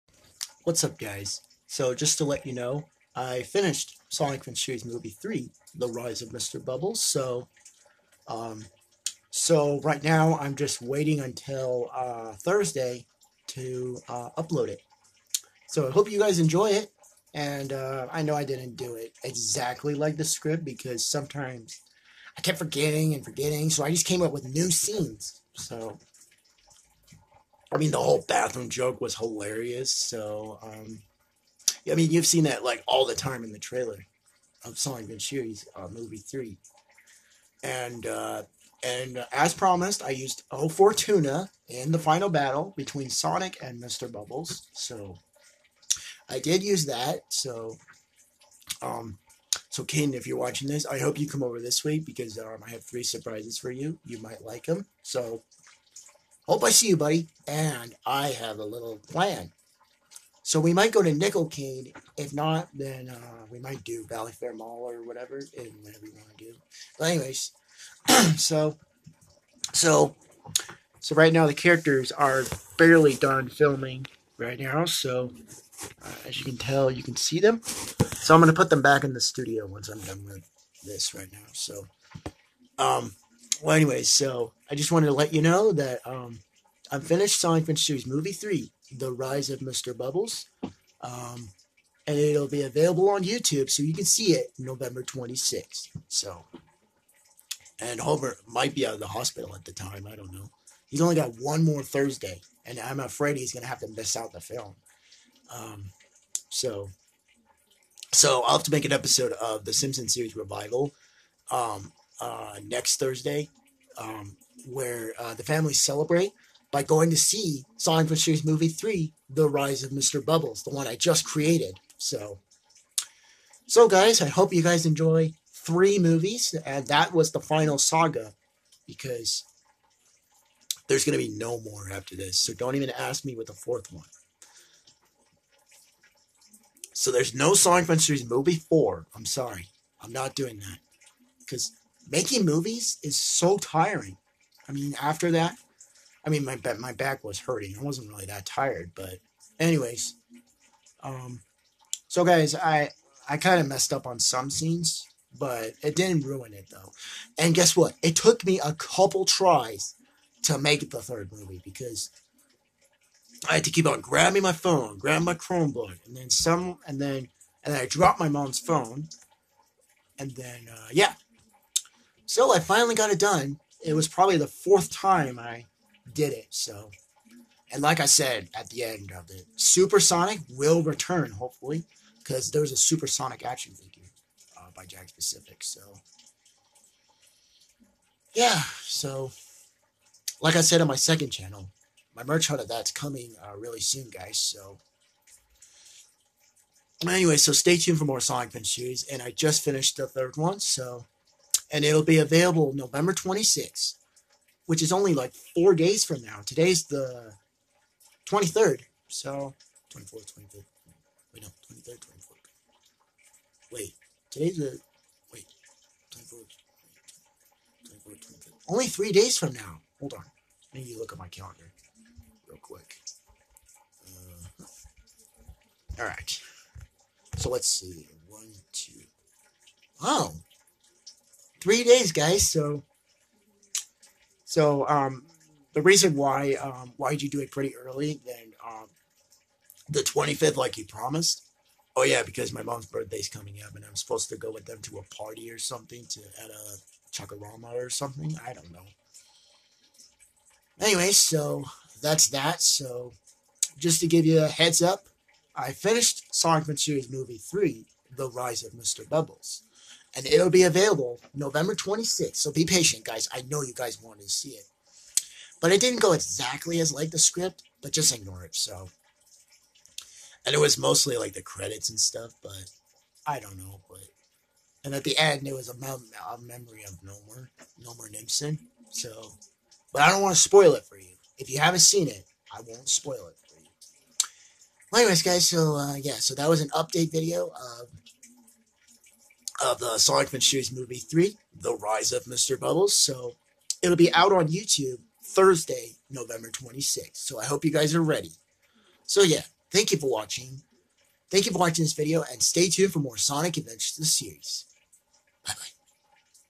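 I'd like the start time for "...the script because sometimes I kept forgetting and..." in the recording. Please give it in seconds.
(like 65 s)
20 s.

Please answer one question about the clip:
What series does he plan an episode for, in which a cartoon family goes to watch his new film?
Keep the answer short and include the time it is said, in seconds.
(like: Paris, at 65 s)
Simpsons series revival, at 109 s.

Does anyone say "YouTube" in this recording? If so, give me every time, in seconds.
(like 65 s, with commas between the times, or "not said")
93 s, 294 s.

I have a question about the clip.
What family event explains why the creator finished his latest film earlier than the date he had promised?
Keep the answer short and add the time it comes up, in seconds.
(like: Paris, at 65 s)
Mom's birthday, at 242 s.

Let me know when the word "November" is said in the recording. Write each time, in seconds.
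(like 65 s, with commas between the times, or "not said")
94 s, 202 s, 261 s, 296 s.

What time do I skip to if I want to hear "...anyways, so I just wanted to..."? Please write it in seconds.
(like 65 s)
83 s.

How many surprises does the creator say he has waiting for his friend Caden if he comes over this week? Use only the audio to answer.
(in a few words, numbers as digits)
3.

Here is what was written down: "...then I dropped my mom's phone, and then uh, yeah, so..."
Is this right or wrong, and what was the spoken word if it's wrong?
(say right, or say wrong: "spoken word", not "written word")
right.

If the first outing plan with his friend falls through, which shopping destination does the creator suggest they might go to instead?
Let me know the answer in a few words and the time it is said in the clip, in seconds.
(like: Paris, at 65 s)
Valley Fair Mall, at 64 s.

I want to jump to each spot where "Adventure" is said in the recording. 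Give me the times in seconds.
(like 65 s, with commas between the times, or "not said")
87 s, 303 s.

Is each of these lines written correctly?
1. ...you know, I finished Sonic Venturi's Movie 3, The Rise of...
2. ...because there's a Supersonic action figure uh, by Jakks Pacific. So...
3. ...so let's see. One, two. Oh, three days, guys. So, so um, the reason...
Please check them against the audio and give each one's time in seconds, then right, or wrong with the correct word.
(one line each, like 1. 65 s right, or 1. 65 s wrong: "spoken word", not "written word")
1. 2 s right
2. 182 s right
3. 227 s right.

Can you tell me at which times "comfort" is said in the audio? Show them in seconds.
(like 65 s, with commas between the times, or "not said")
not said.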